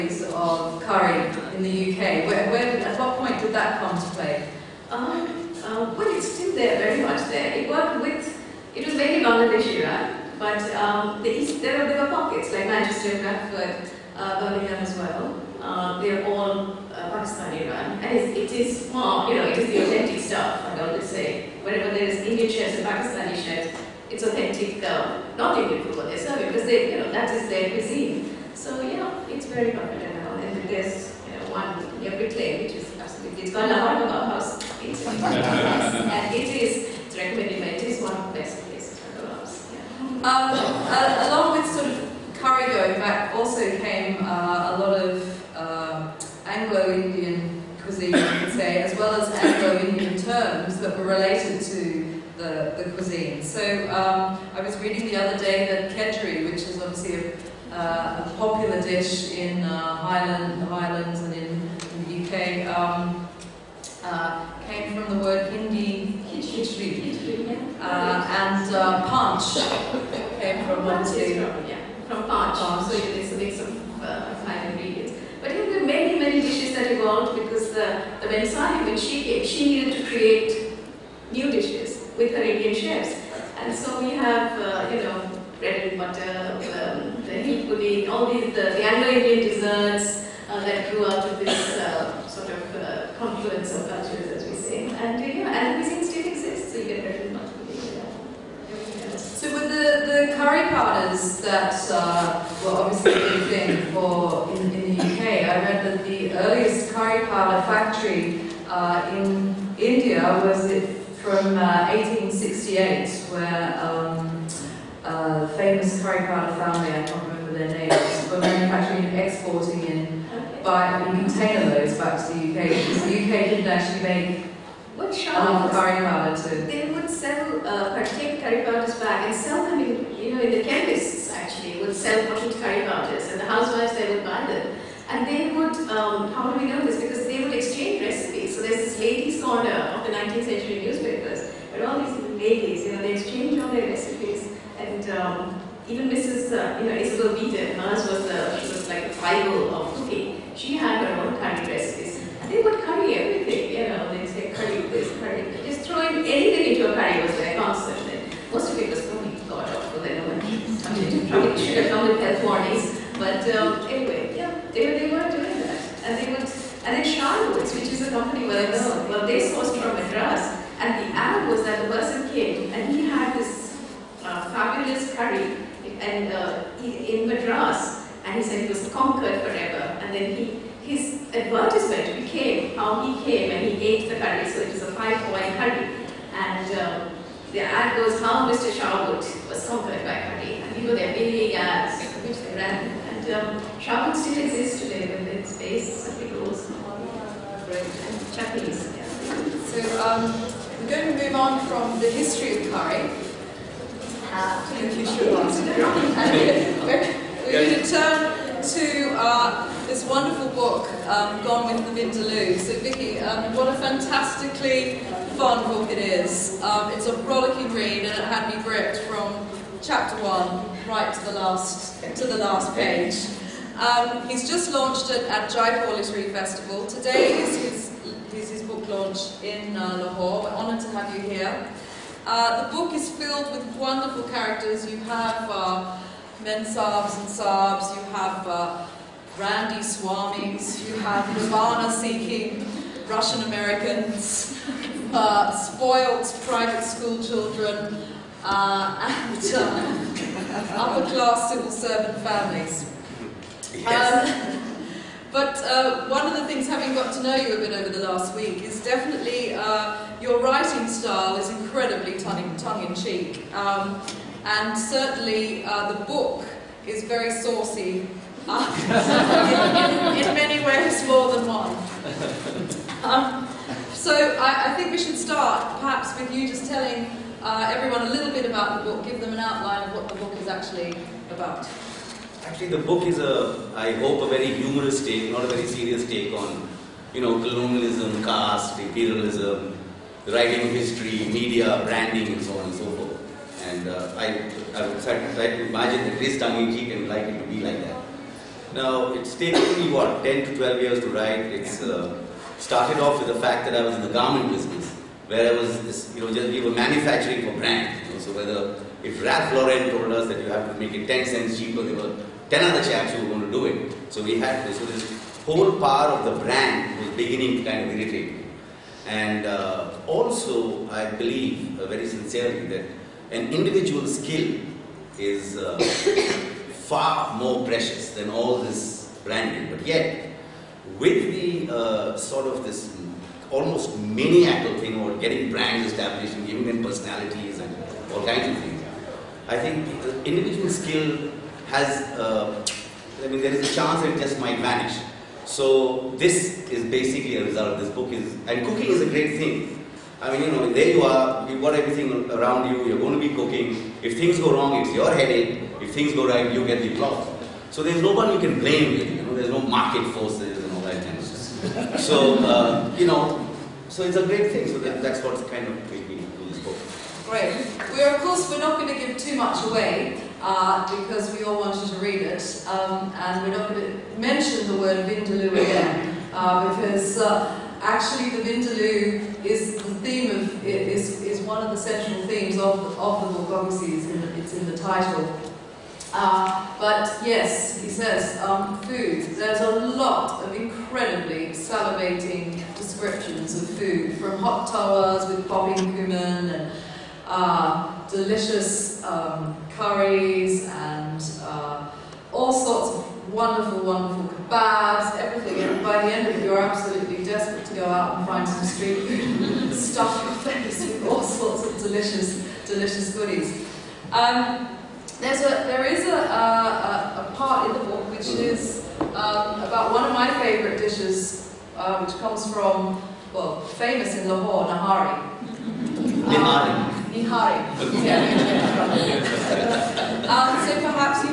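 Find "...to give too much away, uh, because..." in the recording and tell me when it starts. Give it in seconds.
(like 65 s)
368 s.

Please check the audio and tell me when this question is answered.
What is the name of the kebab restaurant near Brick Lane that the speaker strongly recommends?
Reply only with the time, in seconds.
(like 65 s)
33 s.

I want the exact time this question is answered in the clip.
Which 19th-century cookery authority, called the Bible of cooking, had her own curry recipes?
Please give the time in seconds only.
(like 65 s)
146 s.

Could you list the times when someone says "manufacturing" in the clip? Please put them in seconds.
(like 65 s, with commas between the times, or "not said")
118 s, 306 s.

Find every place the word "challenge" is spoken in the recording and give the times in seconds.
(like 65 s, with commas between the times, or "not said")
not said.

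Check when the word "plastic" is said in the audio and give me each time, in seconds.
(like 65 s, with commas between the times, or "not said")
not said.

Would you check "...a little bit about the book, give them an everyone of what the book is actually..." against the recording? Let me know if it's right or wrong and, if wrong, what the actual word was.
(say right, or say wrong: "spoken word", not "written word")
wrong: "outline", not "everyone".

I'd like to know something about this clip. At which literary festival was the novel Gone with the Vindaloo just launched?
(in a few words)
Jaipur Literary Festival.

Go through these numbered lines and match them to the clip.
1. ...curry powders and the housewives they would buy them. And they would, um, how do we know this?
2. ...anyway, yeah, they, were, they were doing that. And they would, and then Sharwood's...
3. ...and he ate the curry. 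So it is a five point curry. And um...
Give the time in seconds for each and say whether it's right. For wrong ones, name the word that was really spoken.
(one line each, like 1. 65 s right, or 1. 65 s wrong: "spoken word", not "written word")
1. 132 s right
2. 163 s right
3. 183 s right.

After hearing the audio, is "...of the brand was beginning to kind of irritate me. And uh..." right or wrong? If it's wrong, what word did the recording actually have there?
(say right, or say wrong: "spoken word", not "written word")
right.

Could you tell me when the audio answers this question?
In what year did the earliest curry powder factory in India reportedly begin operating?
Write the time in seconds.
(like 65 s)
111 s.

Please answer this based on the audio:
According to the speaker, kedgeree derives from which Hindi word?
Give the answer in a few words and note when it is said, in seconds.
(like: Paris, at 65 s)
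khichdi, at 66 s.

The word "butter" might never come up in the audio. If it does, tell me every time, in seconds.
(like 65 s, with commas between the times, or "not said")
85 s, 97 s.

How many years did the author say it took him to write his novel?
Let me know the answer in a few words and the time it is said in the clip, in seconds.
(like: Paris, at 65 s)
10 to 12 years, at 300 s.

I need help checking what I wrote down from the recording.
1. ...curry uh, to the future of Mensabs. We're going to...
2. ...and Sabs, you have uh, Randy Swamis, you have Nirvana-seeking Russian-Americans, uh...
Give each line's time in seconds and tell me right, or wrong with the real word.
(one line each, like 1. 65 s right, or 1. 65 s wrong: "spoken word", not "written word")
1. 202 s wrong: "London", not "Mensabs"
2. 237 s right.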